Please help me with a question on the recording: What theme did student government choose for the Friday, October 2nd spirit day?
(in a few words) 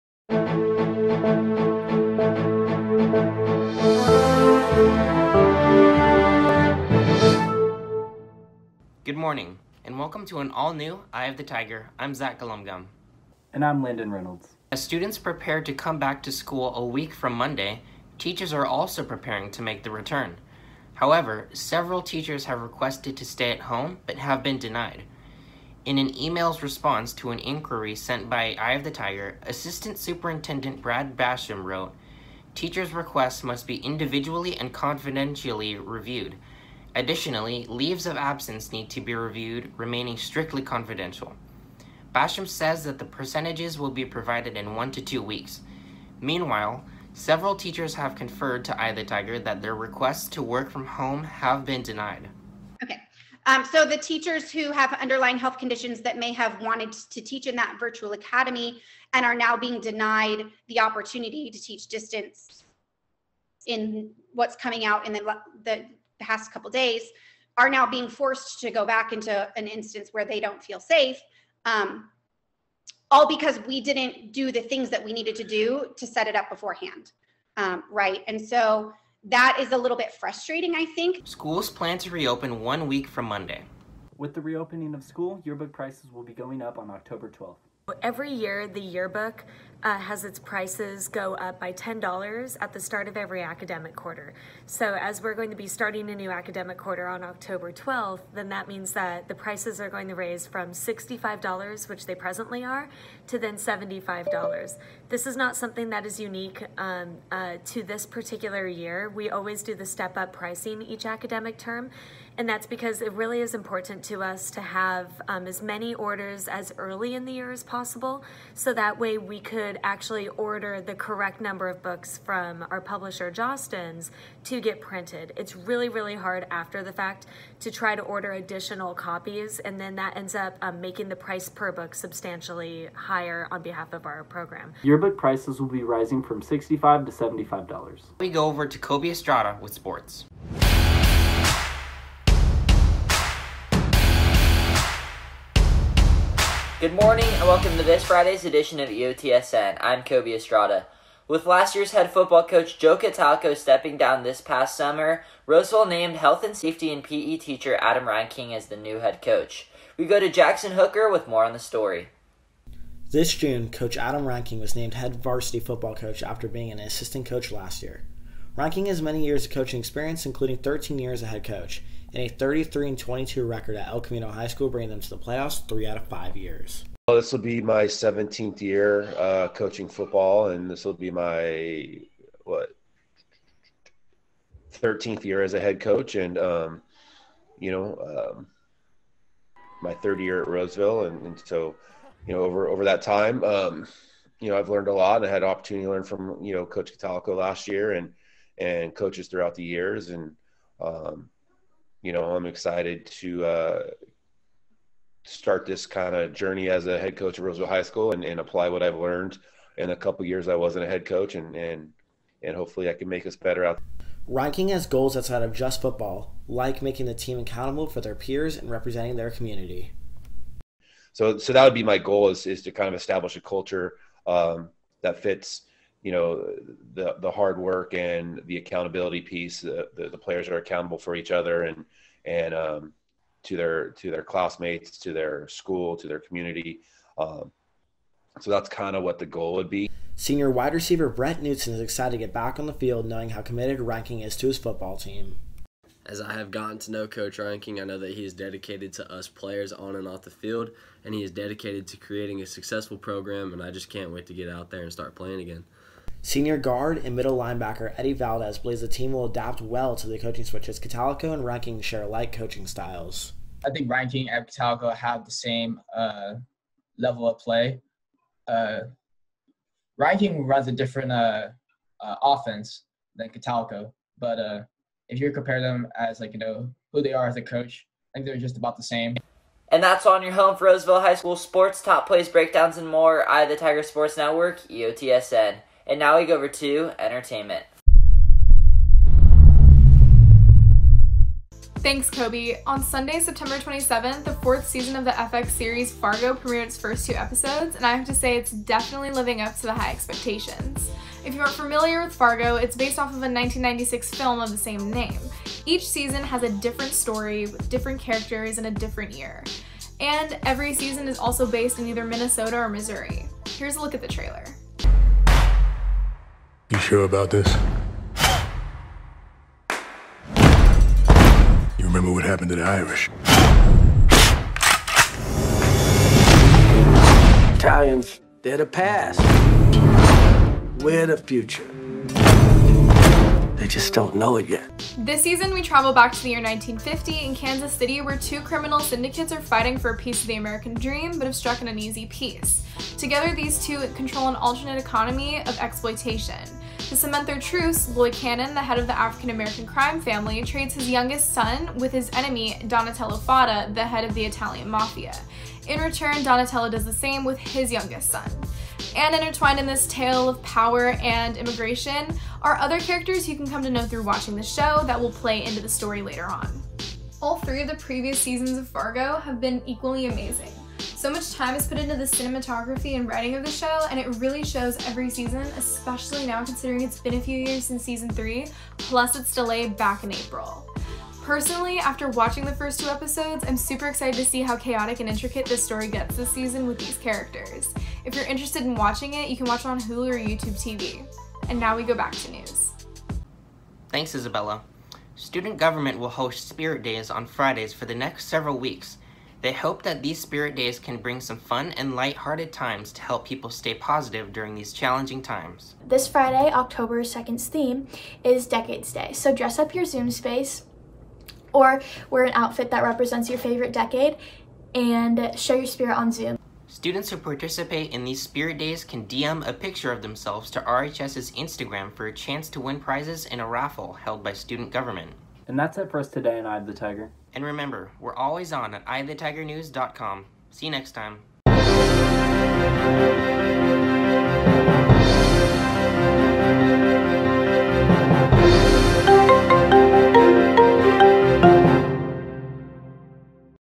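Decades Day.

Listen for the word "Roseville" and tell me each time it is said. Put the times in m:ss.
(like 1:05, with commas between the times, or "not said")
2:35, 3:10, 3:27, 4:40.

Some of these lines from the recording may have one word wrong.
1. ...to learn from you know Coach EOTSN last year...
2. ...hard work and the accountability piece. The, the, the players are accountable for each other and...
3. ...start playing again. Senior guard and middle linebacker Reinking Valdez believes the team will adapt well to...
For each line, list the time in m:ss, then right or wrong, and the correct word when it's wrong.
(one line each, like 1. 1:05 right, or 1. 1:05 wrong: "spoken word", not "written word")
1. 3:15 wrong: "Catalico", not "EOTSN"
2. 3:47 right
3. 4:14 wrong: "Eddie", not "Reinking".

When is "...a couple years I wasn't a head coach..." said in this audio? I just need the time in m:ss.
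3:29.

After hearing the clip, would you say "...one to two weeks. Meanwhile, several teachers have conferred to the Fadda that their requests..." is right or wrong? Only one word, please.
wrong.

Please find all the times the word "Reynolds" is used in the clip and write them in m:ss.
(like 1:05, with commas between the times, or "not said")
0:14.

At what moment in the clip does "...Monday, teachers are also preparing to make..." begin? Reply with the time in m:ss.
0:17.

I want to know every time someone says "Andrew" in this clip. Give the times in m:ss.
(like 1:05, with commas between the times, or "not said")
not said.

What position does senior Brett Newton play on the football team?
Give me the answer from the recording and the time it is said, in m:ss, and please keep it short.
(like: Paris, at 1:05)
wide receiver, at 4:00.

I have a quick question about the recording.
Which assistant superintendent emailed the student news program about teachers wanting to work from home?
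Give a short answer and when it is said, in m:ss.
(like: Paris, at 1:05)
Brad Basham, at 0:30.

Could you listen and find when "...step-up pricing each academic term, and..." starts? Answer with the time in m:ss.
1:49.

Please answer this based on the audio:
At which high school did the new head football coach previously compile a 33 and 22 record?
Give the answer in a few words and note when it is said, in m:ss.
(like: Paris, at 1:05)
El Camino High School, at 2:53.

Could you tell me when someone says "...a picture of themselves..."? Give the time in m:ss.
6:59.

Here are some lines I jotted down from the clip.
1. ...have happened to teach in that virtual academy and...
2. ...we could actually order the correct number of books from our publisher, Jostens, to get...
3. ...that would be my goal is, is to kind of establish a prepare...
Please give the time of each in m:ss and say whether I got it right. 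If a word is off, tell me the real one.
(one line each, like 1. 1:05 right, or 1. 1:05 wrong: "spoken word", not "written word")
1. 0:56 wrong: "wanted", not "happened"
2. 1:59 right
3. 3:41 wrong: "culture", not "prepare".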